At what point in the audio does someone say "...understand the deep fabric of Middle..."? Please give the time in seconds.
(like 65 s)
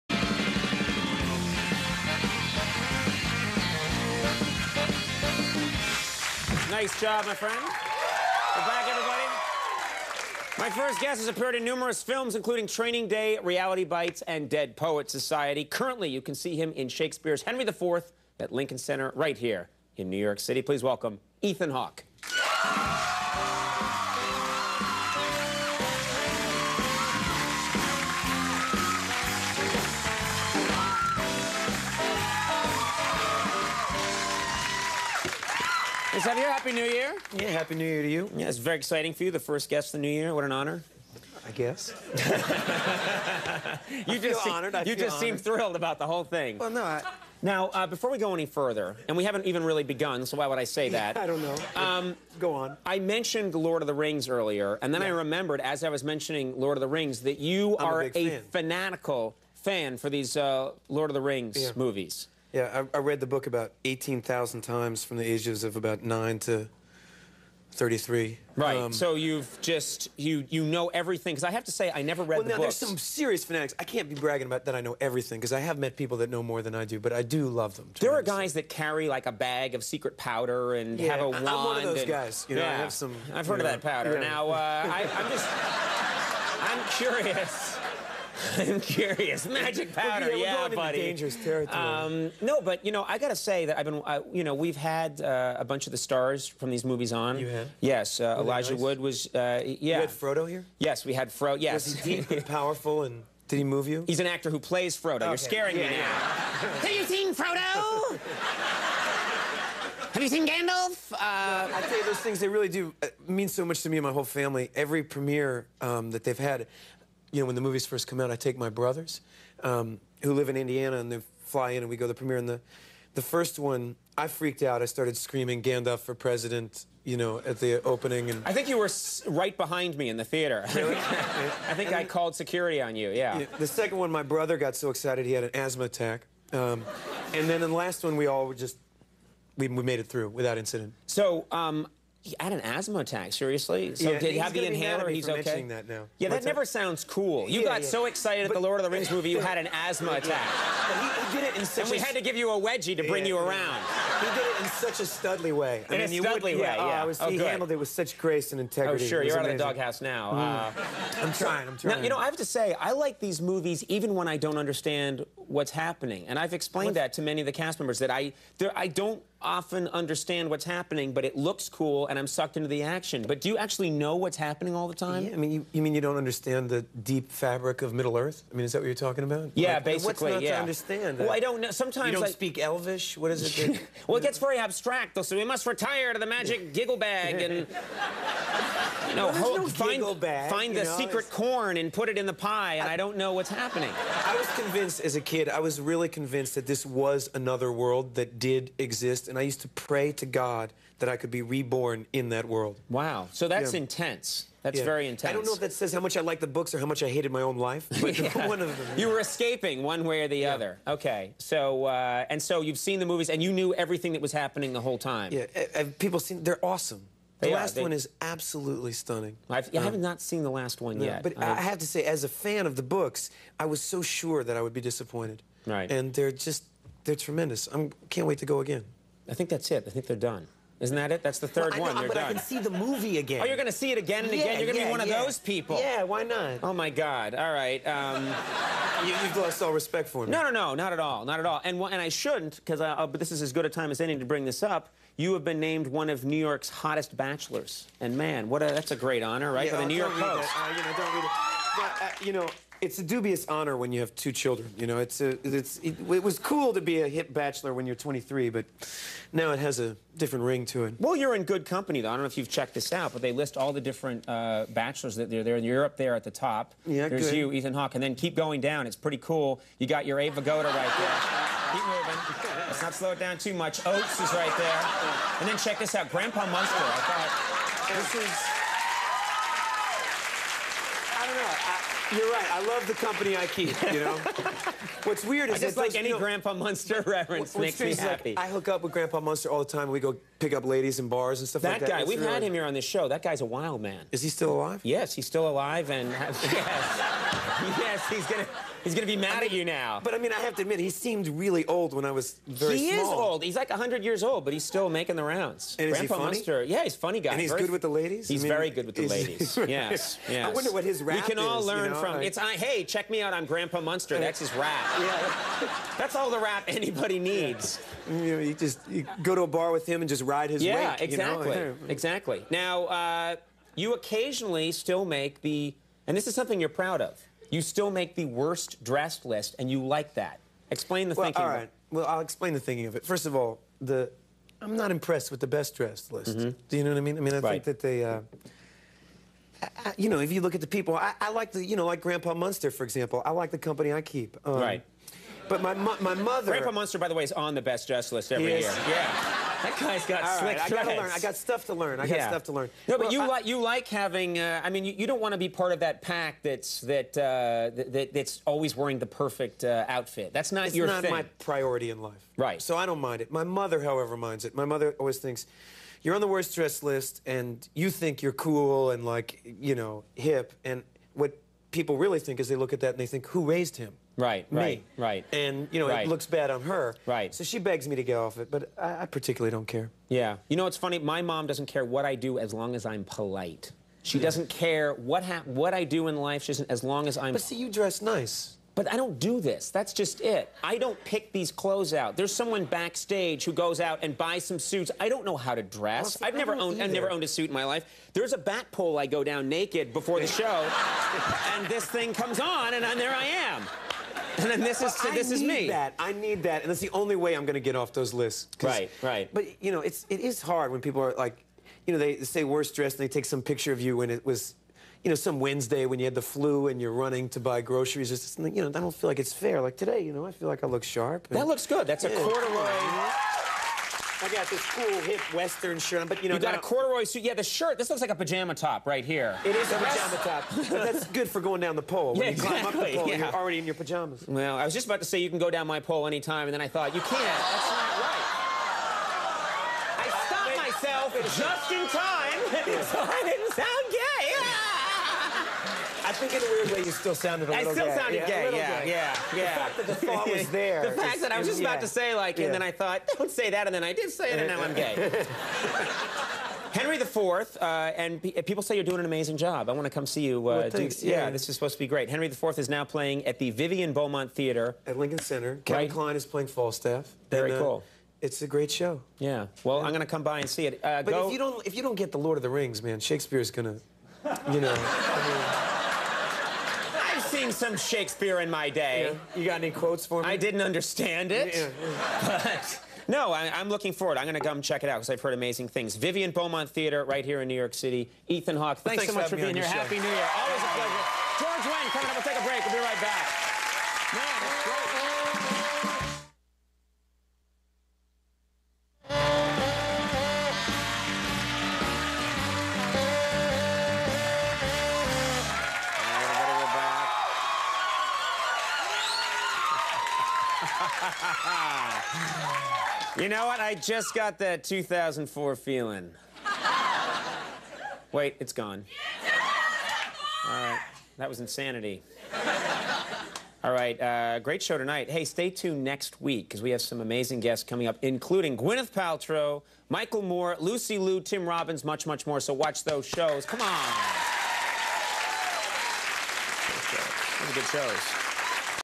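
176 s.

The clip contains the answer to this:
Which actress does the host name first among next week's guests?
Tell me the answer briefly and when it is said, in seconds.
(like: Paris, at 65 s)
Gwyneth Paltrow, at 528 s.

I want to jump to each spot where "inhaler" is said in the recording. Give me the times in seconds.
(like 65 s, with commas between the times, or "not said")
144 s.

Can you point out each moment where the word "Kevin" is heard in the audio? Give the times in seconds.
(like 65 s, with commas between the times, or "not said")
465 s.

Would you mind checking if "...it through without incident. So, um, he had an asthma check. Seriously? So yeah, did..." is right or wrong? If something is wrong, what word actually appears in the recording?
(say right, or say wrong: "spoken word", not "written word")
wrong: "attack", not "check".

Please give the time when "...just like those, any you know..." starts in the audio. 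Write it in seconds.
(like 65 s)
285 s.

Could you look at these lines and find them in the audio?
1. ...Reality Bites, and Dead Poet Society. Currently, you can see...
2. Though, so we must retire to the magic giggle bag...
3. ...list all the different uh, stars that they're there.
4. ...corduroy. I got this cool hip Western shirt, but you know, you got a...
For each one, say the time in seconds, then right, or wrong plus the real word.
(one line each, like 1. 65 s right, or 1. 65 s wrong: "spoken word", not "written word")
1. 13 s right
2. 185 s right
3. 263 s wrong: "bachelors", not "stars"
4. 422 s right.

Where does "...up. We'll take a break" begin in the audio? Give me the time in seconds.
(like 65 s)
492 s.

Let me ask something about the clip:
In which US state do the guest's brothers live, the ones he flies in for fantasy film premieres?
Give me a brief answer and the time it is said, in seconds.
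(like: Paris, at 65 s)
Indiana, at 120 s.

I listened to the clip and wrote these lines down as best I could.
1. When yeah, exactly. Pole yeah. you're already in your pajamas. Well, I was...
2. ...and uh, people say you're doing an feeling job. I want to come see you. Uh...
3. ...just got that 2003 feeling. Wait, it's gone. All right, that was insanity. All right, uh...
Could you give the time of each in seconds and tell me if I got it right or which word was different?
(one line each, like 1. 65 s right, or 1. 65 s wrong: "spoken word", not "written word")
1. 432 s right
2. 457 s wrong: "amazing", not "feeling"
3. 513 s wrong: "2004", not "2003".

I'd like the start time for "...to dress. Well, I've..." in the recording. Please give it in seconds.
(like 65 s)
395 s.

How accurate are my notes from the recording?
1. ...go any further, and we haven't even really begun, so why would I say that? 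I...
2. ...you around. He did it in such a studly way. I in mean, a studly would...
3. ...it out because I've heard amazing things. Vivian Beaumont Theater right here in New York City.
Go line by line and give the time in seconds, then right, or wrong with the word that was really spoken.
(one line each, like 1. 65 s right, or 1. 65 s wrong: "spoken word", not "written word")
1. 48 s right
2. 153 s right
3. 484 s right.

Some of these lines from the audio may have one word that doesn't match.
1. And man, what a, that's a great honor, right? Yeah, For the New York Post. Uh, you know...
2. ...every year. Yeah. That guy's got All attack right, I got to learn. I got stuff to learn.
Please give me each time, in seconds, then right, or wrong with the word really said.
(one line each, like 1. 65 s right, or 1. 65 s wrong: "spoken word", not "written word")
1. 247 s right
2. 348 s wrong: "slick", not "attack".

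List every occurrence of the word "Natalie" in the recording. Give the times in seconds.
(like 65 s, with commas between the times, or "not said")
not said.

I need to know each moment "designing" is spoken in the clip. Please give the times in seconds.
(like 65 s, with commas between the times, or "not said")
not said.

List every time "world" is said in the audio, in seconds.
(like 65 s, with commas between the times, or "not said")
197 s, 202 s.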